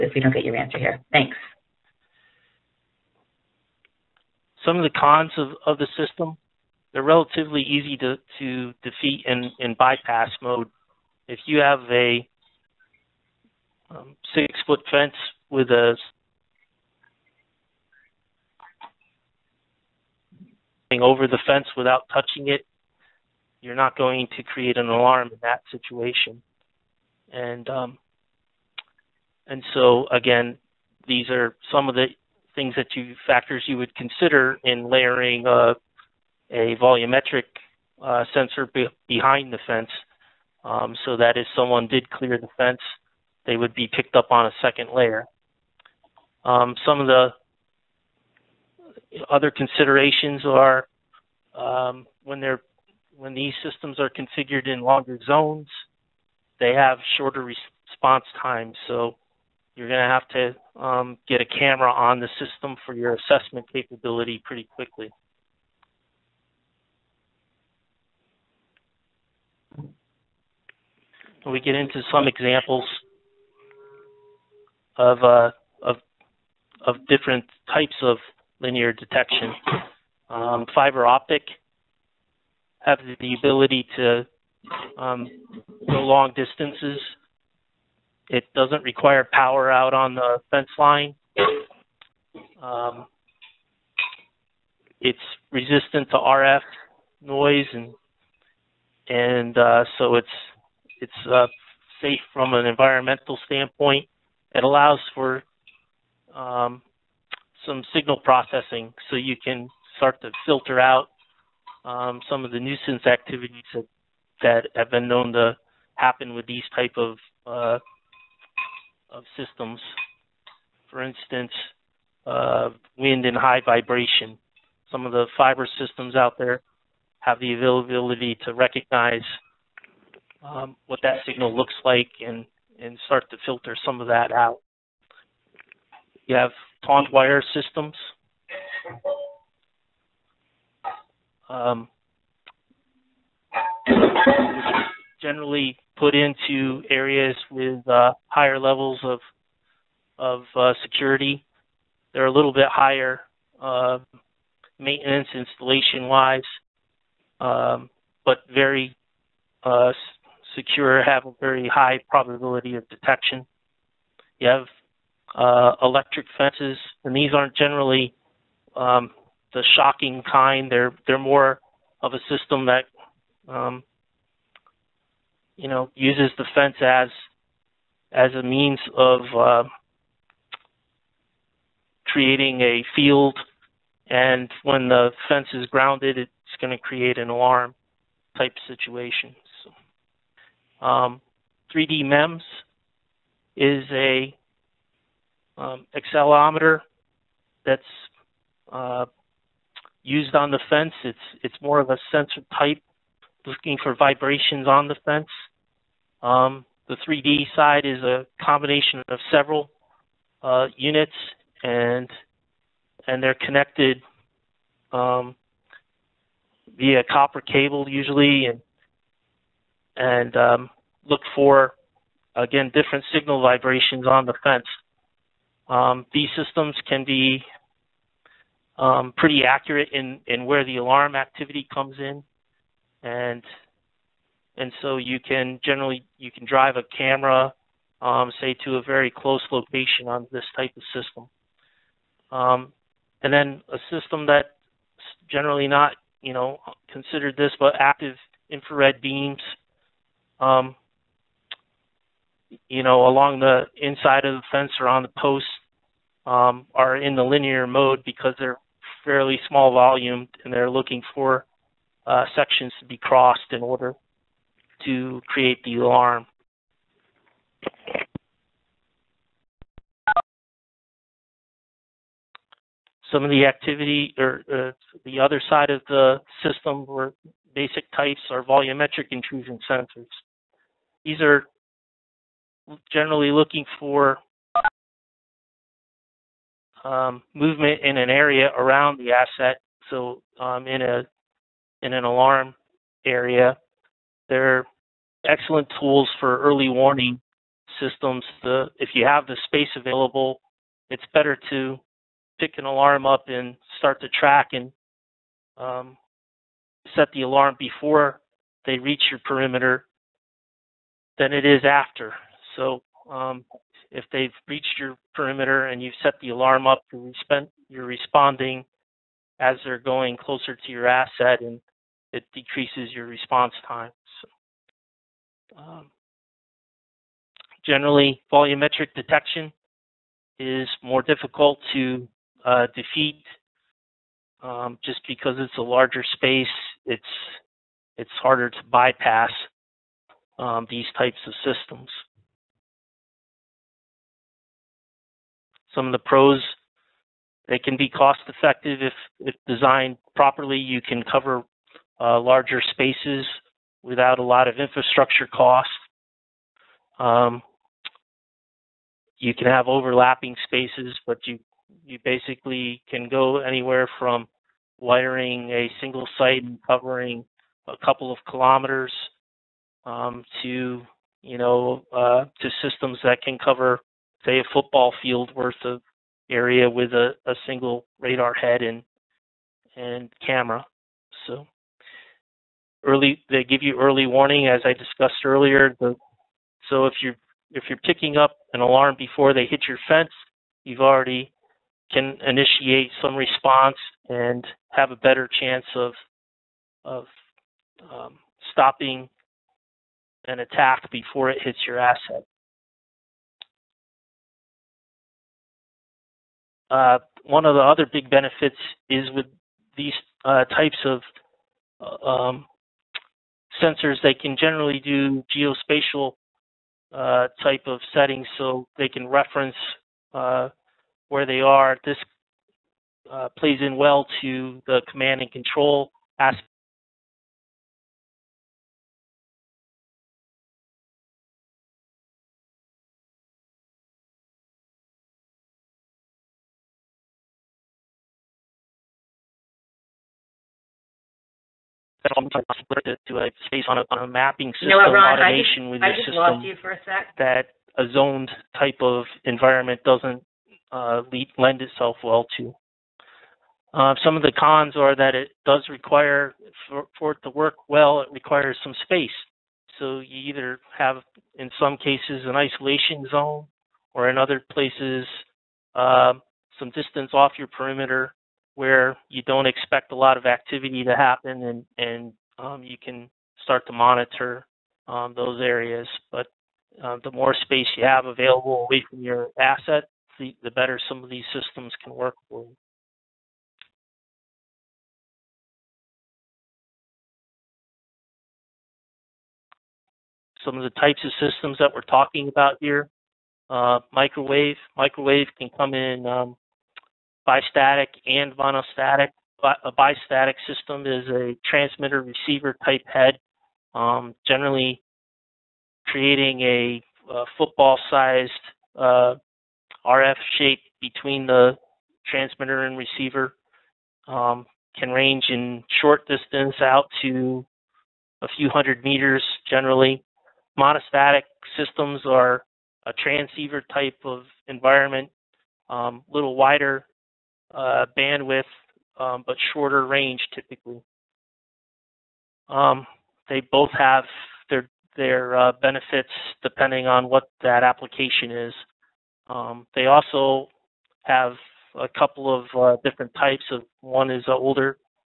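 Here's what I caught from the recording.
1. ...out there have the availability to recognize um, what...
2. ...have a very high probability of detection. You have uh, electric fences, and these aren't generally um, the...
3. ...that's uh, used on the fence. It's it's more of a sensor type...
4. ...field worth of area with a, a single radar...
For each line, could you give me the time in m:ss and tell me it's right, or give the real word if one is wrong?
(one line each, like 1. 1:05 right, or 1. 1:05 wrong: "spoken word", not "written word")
1. 2:06 right
2. 2:41 right
3. 3:17 right
4. 6:14 right.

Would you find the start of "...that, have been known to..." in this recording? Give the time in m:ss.
1:54.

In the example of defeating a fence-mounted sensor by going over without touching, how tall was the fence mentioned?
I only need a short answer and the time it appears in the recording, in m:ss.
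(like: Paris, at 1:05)
6 foot, at 0:14.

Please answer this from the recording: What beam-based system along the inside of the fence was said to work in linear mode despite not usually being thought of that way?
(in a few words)
Active infrared beams.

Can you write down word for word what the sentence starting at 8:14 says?
Microwave can come in um, bistatic and monostatic.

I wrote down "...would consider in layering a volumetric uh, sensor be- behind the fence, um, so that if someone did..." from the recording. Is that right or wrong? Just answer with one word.
right.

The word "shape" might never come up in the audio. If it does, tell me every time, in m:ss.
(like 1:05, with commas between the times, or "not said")
8:30.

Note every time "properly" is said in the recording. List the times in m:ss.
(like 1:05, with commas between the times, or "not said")
5:50.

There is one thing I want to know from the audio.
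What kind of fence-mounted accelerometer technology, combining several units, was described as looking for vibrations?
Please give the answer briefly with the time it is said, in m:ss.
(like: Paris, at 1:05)
3D MEMS, at 3:11.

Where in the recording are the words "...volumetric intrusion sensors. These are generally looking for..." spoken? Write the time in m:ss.
4:38.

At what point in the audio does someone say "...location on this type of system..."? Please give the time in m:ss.
3:59.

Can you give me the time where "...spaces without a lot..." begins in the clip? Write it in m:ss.
5:52.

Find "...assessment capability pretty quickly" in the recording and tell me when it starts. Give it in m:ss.
1:03.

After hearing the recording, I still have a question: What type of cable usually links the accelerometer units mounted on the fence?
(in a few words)
Copper.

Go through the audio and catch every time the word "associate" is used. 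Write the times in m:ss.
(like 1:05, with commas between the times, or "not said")
not said.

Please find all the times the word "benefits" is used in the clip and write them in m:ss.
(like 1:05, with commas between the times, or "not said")
6:48, 8:55.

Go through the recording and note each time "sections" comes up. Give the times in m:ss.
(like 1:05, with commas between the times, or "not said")
4:22.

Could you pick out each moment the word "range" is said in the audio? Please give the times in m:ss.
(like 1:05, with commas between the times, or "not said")
8:34, 8:49.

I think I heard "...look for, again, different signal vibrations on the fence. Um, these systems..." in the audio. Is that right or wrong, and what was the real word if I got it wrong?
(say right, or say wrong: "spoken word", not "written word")
right.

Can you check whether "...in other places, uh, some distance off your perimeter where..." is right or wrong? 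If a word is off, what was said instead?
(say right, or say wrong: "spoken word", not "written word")
right.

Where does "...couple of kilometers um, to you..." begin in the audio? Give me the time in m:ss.
6:07.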